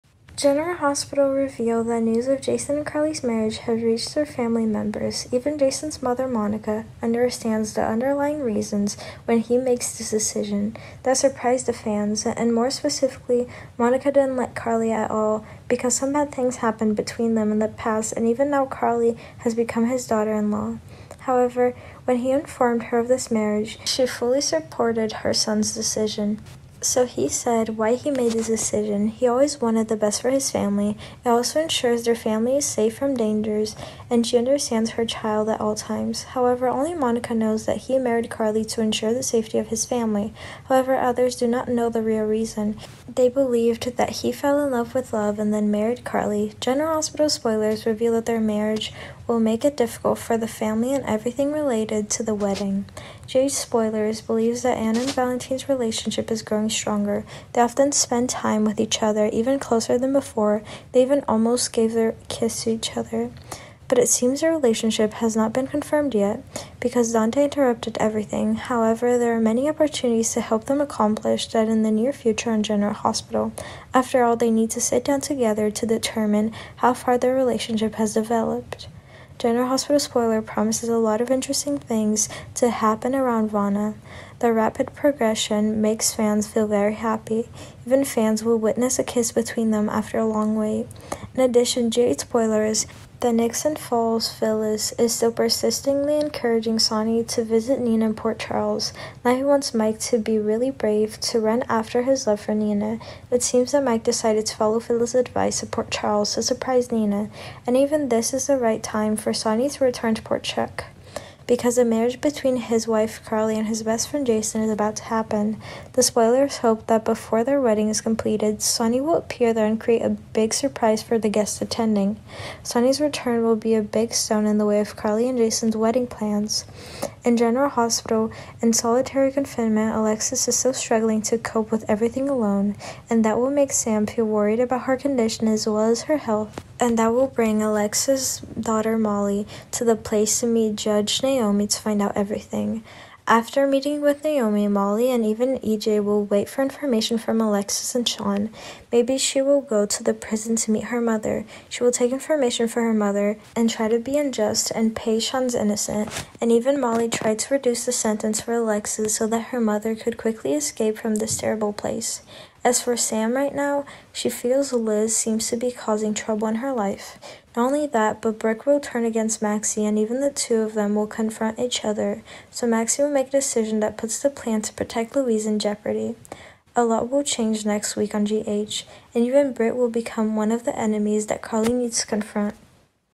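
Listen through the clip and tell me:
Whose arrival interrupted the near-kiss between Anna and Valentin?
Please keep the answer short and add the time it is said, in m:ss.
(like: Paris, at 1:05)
Dante, at 1:07.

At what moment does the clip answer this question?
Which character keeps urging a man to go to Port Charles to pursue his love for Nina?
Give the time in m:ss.
1:34.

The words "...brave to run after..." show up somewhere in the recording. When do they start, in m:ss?
1:40.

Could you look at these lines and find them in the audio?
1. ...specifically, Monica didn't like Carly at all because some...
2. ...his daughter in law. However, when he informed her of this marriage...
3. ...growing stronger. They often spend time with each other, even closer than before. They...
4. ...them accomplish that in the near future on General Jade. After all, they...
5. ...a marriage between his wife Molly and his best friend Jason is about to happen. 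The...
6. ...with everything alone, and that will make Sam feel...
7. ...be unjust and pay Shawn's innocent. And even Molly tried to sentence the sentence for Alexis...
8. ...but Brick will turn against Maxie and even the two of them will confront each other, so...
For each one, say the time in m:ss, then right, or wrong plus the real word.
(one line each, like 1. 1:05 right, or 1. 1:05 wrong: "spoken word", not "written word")
1. 0:12 right
2. 0:19 right
3. 0:56 right
4. 1:10 wrong: "Hospital", not "Jade"
5. 1:51 wrong: "Carly", not "Molly"
6. 2:11 right
7. 2:33 wrong: "reduce", not "sentence"
8. 2:48 right.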